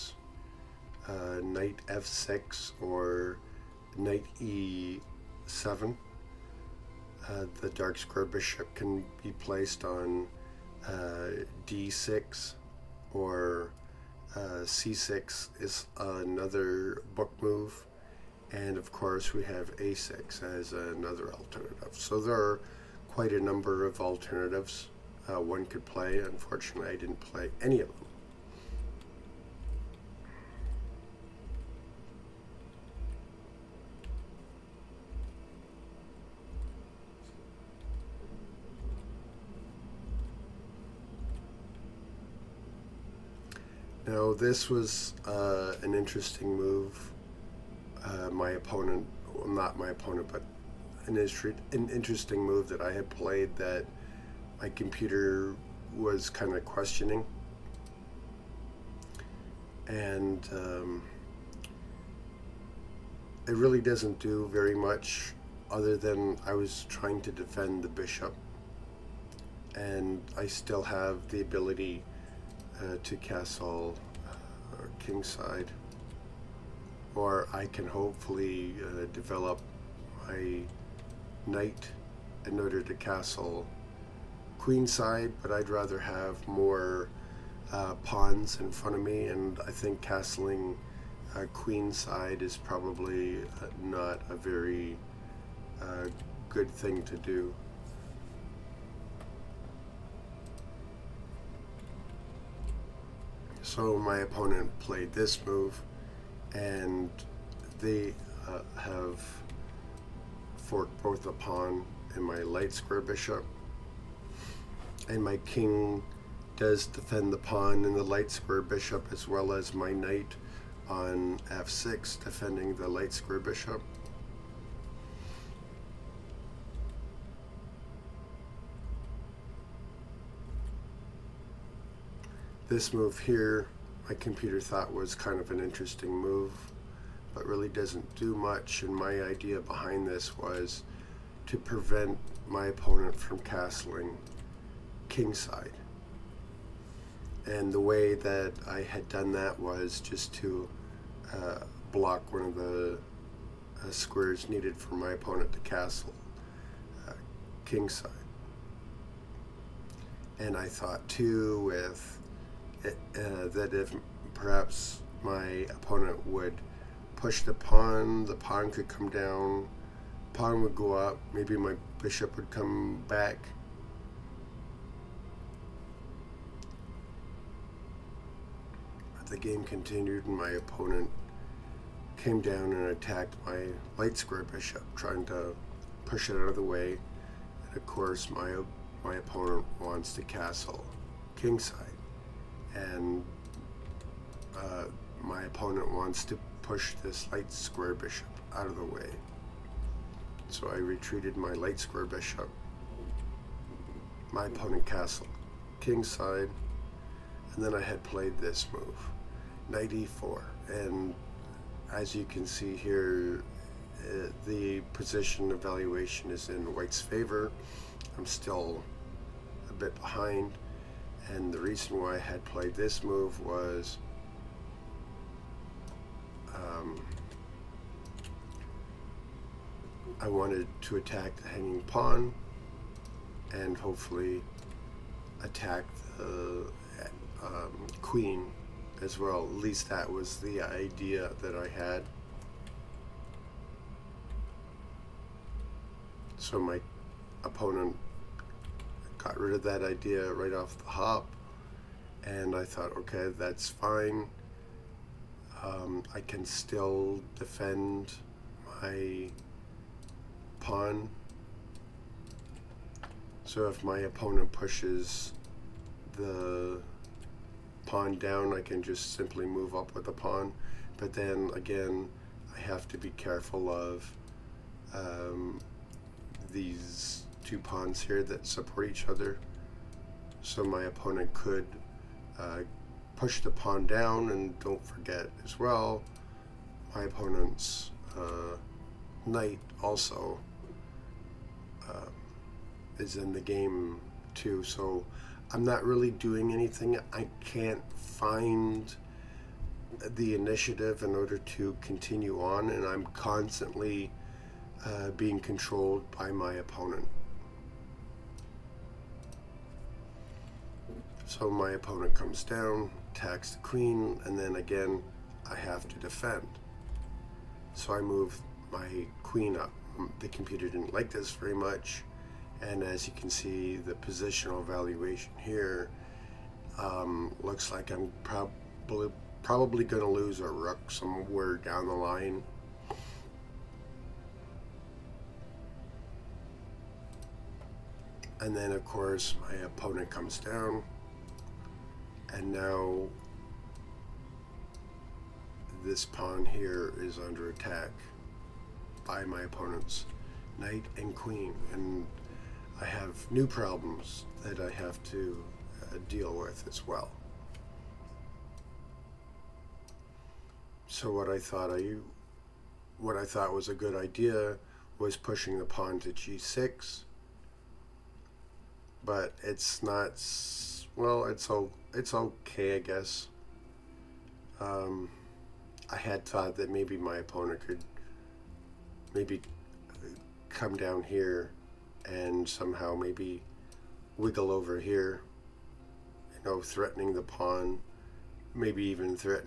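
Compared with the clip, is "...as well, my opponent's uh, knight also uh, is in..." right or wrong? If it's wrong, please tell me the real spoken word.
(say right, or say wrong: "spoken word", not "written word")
right.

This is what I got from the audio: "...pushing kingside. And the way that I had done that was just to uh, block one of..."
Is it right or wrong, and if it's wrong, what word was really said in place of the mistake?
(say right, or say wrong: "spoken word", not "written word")
wrong: "castling", not "pushing".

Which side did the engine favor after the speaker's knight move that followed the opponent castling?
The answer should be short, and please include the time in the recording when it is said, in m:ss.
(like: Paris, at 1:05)
White, at 3:36.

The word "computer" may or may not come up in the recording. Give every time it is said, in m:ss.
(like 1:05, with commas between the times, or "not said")
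0:54, 2:14, 5:20.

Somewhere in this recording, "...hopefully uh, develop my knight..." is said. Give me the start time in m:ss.
1:17.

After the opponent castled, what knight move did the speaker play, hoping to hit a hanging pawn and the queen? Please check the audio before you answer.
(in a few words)
knight e4.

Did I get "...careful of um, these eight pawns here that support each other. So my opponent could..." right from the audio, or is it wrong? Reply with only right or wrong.
wrong.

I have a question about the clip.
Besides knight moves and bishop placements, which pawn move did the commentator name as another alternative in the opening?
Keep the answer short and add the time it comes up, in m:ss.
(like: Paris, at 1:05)
a6, at 0:19.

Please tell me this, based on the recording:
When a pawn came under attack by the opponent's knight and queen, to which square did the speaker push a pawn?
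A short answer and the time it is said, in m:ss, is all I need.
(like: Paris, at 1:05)
g6, at 6:06.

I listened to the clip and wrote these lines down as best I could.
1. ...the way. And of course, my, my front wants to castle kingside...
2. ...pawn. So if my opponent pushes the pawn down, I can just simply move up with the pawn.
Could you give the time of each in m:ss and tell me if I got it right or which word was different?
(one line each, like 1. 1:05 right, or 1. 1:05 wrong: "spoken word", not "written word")
1. 3:06 wrong: "opponent", not "front"
2. 4:20 right.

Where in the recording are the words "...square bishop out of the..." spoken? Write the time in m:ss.
3:17.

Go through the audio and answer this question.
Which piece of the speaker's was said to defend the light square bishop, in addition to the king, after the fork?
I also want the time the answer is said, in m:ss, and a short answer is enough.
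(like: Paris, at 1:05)
knight on f6, at 1:59.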